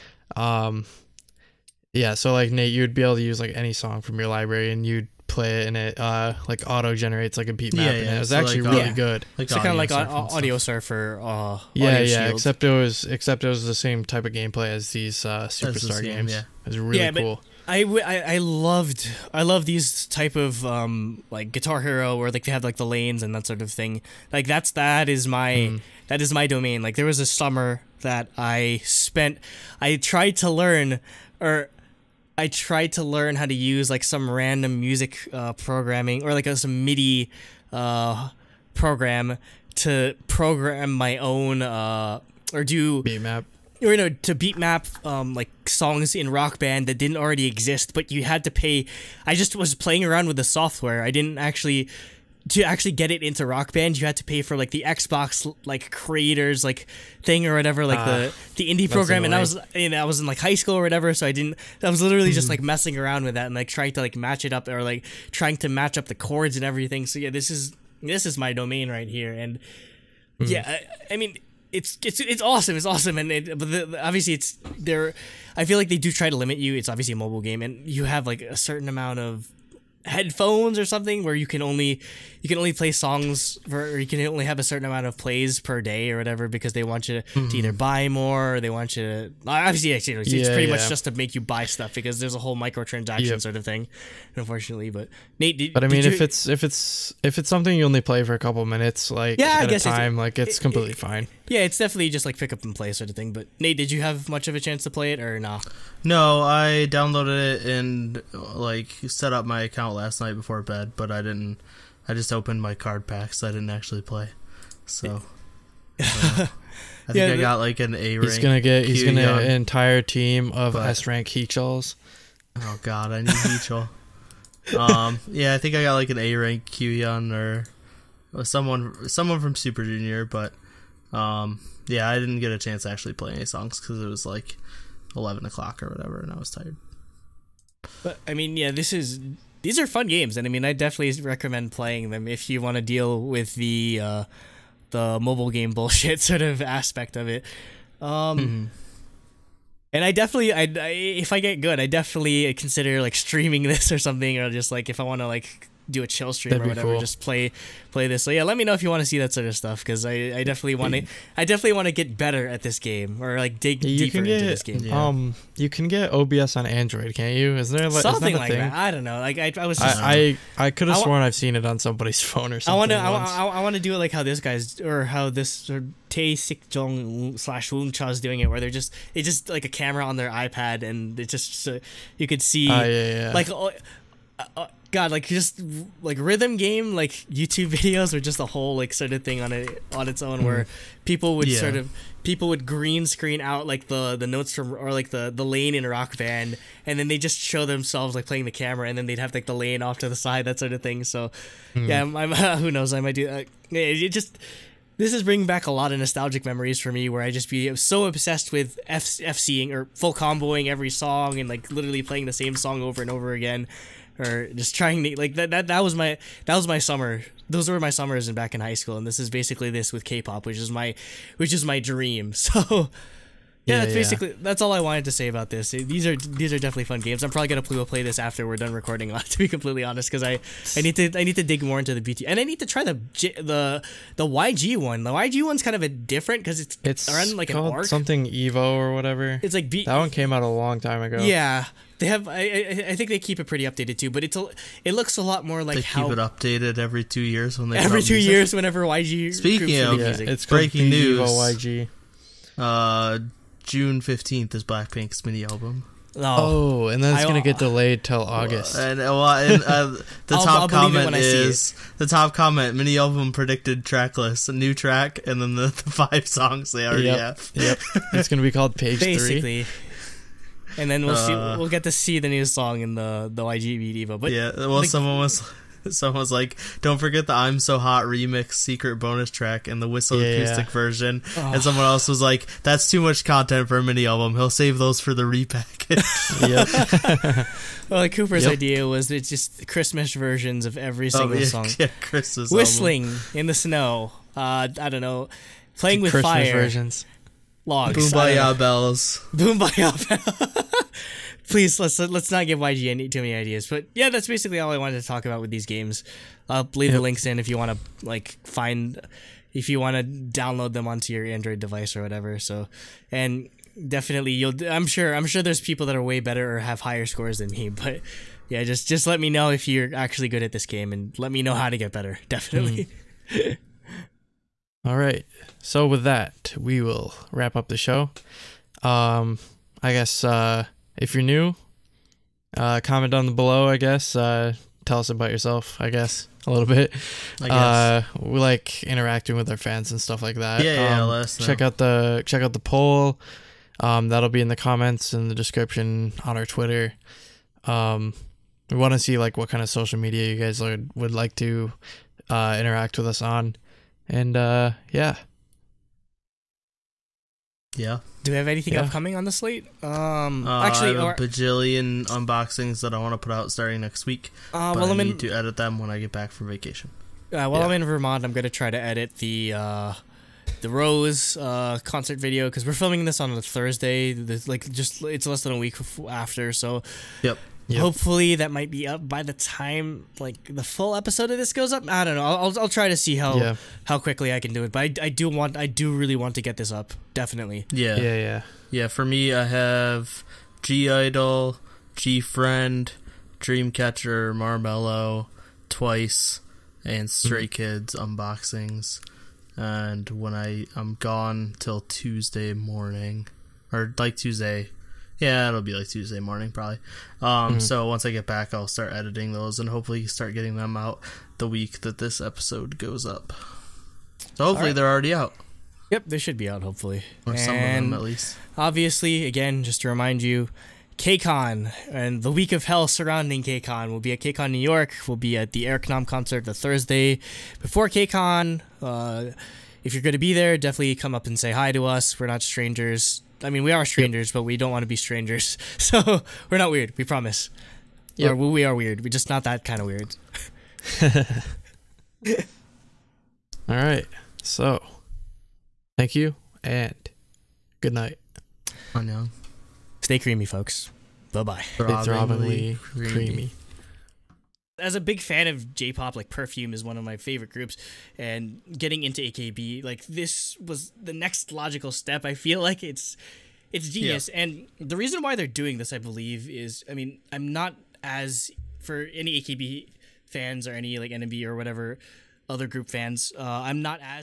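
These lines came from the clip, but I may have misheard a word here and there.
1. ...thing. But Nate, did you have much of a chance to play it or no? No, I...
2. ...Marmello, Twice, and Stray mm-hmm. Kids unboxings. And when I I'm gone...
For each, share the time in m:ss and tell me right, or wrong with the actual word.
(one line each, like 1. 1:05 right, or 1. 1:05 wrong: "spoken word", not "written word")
1. 1:43 right
2. 6:34 right.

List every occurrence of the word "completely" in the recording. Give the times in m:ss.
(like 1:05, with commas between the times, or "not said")
1:40, 3:49.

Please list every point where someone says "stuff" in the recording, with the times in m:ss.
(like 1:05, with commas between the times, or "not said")
1:31, 2:39, 5:39.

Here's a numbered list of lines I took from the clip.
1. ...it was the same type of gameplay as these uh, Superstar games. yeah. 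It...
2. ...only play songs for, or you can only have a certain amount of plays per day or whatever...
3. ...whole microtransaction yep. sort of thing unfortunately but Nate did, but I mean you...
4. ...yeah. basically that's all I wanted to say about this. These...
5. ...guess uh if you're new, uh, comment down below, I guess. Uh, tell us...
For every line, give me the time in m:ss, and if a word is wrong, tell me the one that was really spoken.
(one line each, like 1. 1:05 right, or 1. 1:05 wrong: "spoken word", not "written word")
1. 0:13 right
2. 1:22 right
3. 1:32 right
4. 3:43 right
5. 5:29 right.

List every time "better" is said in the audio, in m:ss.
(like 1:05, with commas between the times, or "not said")
2:42, 5:16, 5:21.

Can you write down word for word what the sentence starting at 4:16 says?
Oh, oh, and then it's gonna get delayed till August.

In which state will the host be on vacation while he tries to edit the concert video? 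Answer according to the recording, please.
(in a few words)
Vermont.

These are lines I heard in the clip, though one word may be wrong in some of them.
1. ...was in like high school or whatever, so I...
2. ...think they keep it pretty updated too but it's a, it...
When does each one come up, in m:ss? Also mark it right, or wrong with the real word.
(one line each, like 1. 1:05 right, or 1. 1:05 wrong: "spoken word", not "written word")
1. 1:00 right
2. 4:02 right.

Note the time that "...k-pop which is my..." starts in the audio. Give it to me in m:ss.
3:40.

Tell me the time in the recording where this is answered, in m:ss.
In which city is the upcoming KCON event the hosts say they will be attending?
7:04.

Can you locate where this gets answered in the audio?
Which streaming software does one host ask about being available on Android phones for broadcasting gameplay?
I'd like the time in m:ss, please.
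2:46.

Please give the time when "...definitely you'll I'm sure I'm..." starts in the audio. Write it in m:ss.
5:13.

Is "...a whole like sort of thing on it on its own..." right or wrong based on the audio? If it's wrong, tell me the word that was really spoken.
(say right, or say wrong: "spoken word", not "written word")
right.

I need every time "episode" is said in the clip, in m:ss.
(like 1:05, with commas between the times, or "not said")
6:20, 6:52.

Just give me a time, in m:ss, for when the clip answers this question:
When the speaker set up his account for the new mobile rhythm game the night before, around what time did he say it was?
2:15.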